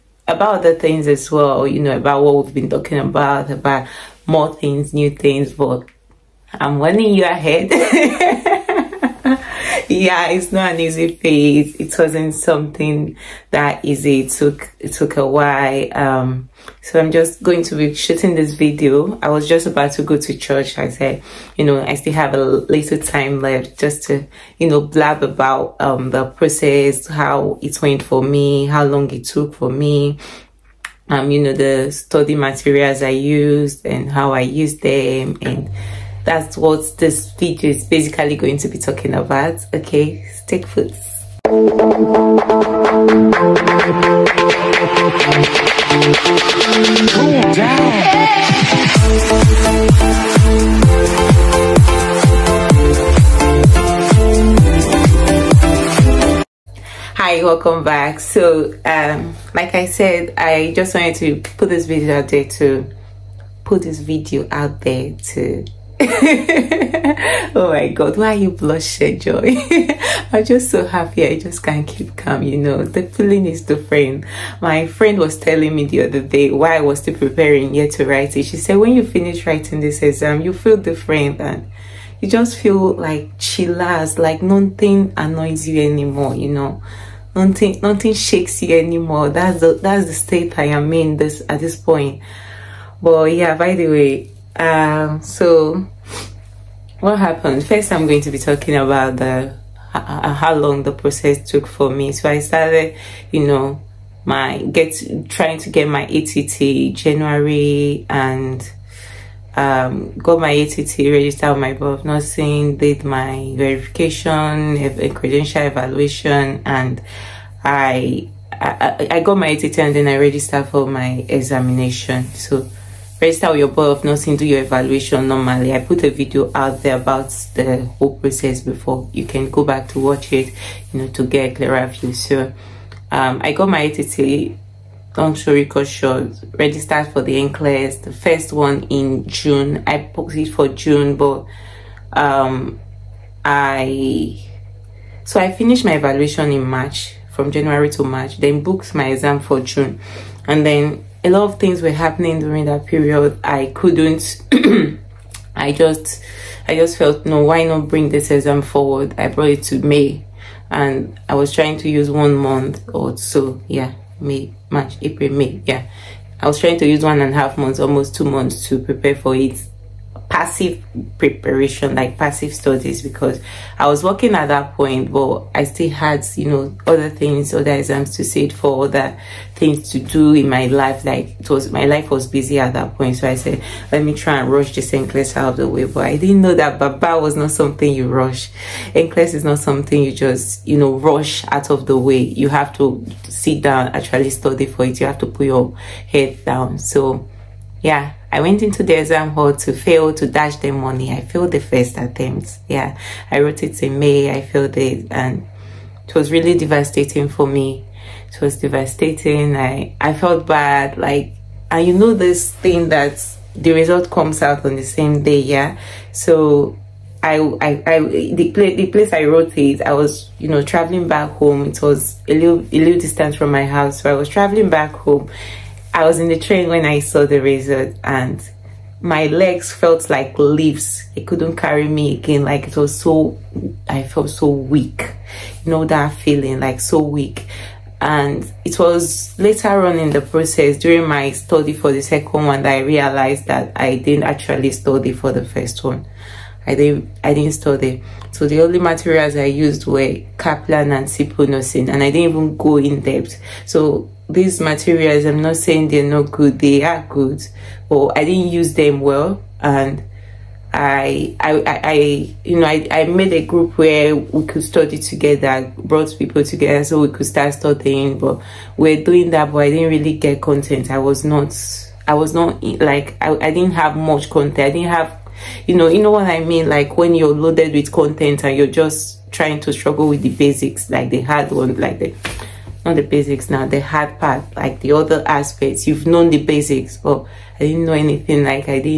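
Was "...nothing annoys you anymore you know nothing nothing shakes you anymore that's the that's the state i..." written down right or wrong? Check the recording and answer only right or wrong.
right.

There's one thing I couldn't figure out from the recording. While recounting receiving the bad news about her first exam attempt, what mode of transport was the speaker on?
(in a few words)
train.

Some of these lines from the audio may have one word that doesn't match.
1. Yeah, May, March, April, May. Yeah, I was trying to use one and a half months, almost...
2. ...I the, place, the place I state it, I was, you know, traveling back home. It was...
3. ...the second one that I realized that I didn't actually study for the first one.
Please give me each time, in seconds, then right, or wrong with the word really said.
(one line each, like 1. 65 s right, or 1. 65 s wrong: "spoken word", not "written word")
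1. 163 s right
2. 217 s wrong: "wrote", not "state"
3. 241 s right.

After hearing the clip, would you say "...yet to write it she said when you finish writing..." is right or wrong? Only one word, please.
right.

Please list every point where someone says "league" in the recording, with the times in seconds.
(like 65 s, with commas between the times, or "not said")
not said.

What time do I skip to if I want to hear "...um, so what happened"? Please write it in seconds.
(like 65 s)
94 s.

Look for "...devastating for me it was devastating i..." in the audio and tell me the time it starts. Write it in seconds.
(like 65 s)
206 s.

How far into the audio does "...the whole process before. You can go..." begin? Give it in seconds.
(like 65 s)
127 s.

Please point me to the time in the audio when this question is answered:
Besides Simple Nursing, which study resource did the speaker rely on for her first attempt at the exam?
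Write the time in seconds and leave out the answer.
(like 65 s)
250 s.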